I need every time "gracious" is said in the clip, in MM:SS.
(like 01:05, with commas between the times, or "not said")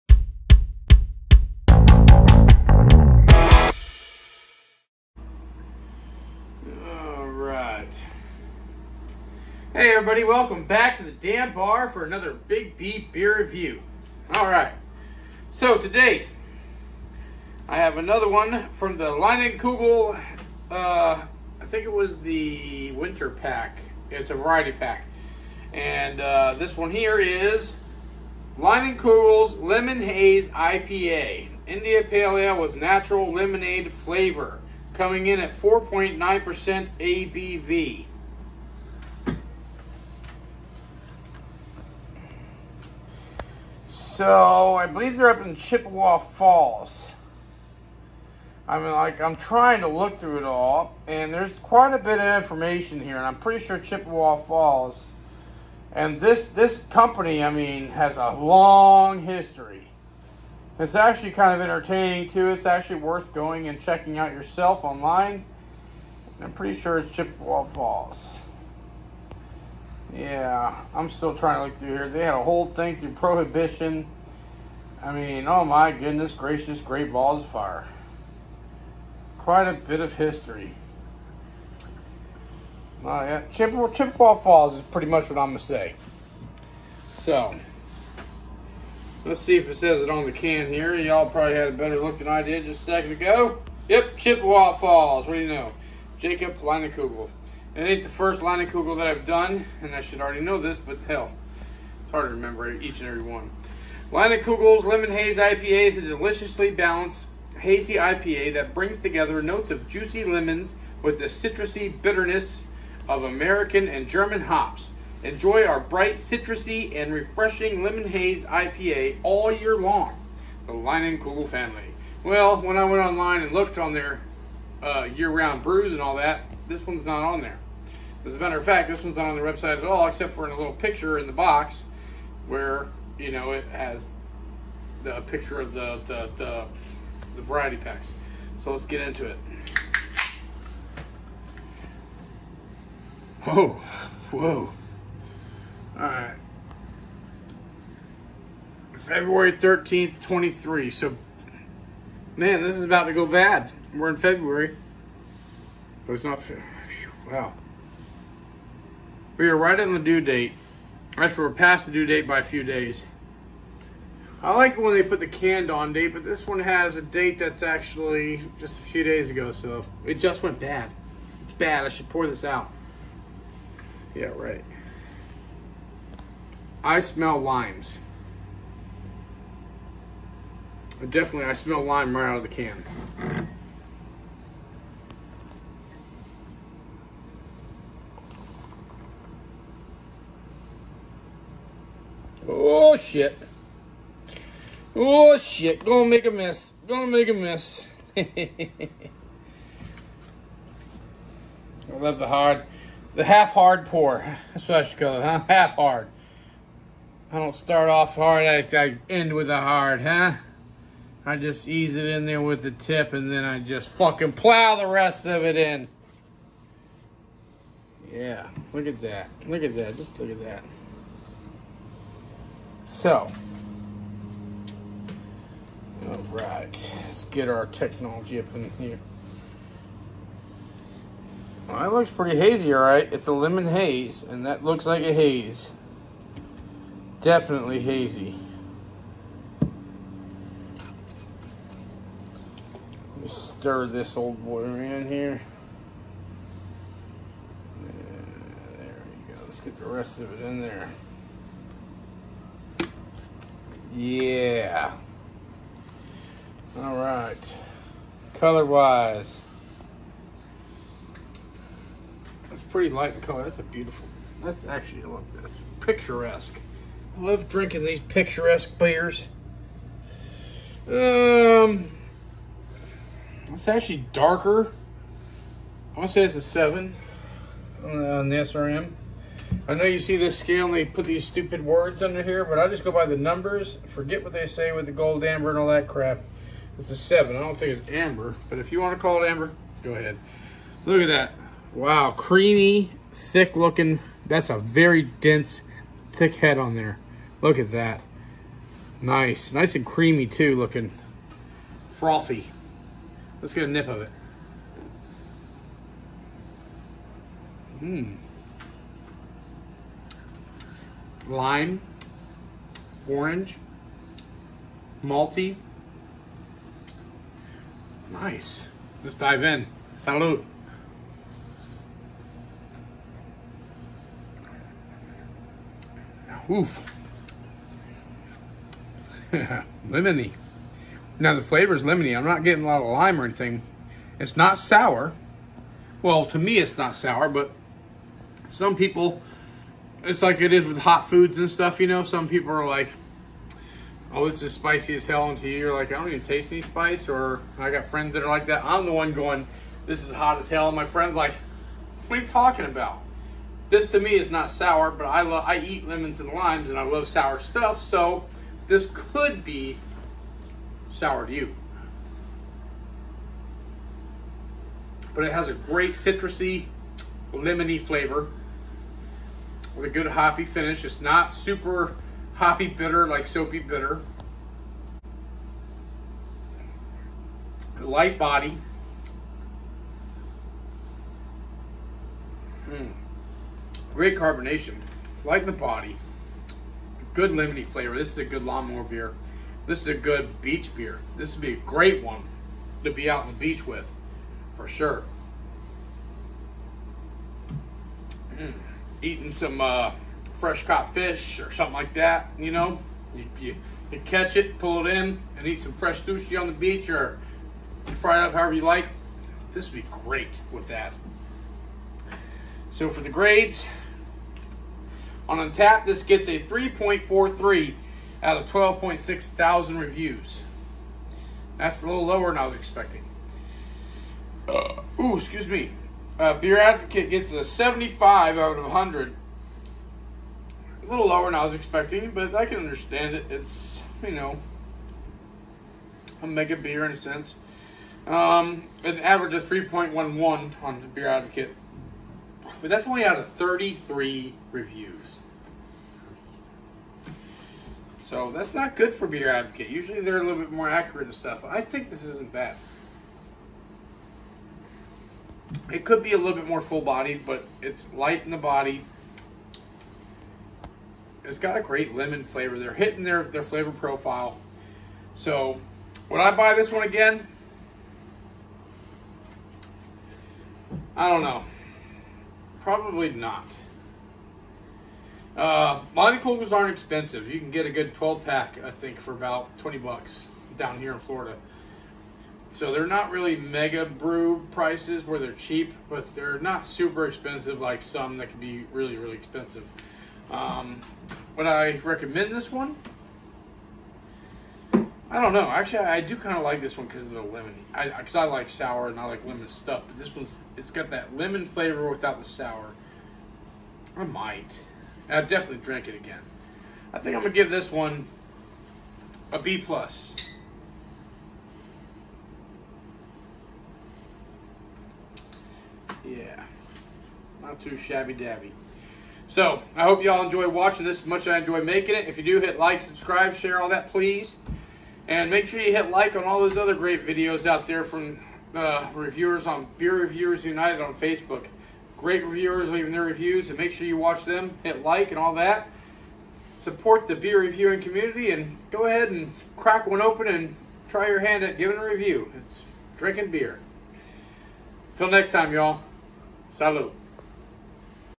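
01:16.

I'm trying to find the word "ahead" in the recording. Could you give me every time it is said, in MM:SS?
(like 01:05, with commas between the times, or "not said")
04:49, 08:58.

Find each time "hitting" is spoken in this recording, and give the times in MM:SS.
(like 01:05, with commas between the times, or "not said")
07:42.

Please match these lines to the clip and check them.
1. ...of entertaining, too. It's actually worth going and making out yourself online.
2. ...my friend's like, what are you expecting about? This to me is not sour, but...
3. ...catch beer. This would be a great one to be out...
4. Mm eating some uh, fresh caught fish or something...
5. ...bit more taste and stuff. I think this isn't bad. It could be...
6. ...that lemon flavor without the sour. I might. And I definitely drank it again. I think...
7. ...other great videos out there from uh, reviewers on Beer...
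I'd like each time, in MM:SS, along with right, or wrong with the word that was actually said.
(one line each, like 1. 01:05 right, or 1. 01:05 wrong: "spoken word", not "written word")
1. 01:01 wrong: "checking", not "making"
2. 05:50 wrong: "talking", not "expecting"
3. 06:30 wrong: "beach", not "catch"
4. 06:38 right
5. 07:30 wrong: "accurate", not "taste"
6. 08:20 right
7. 08:46 right.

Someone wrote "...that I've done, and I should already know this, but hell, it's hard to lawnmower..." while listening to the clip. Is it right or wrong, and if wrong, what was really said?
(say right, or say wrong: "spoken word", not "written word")
wrong: "remember", not "lawnmower".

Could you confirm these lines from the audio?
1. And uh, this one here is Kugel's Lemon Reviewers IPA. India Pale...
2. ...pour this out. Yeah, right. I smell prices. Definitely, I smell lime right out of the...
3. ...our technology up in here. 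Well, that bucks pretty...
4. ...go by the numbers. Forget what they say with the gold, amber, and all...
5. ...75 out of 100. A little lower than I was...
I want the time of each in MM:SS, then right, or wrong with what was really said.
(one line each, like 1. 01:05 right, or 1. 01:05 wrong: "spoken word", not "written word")
1. 00:25 wrong: "Haze", not "Reviewers"
2. 02:52 wrong: "limes", not "prices"
3. 03:47 wrong: "looks", not "bucks"
4. 04:42 right
5. 07:07 right.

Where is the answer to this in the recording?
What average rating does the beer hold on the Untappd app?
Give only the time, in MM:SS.
06:56.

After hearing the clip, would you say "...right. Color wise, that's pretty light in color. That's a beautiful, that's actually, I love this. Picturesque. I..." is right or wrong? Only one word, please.
right.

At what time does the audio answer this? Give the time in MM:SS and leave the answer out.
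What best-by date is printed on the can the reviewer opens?
02:28.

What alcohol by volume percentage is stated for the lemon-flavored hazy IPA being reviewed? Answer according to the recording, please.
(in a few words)
4.9%.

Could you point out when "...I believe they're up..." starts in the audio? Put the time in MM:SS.
00:44.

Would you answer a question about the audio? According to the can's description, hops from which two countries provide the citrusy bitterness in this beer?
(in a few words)
American and German.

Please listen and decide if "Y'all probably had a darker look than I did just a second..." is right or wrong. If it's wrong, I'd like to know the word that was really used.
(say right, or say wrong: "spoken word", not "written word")
wrong: "better", not "darker".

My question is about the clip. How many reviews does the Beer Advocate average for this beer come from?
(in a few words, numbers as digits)
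33.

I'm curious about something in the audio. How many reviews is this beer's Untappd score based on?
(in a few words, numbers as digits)
12.6 thousand.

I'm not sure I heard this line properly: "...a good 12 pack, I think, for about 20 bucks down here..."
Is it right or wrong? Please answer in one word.
right.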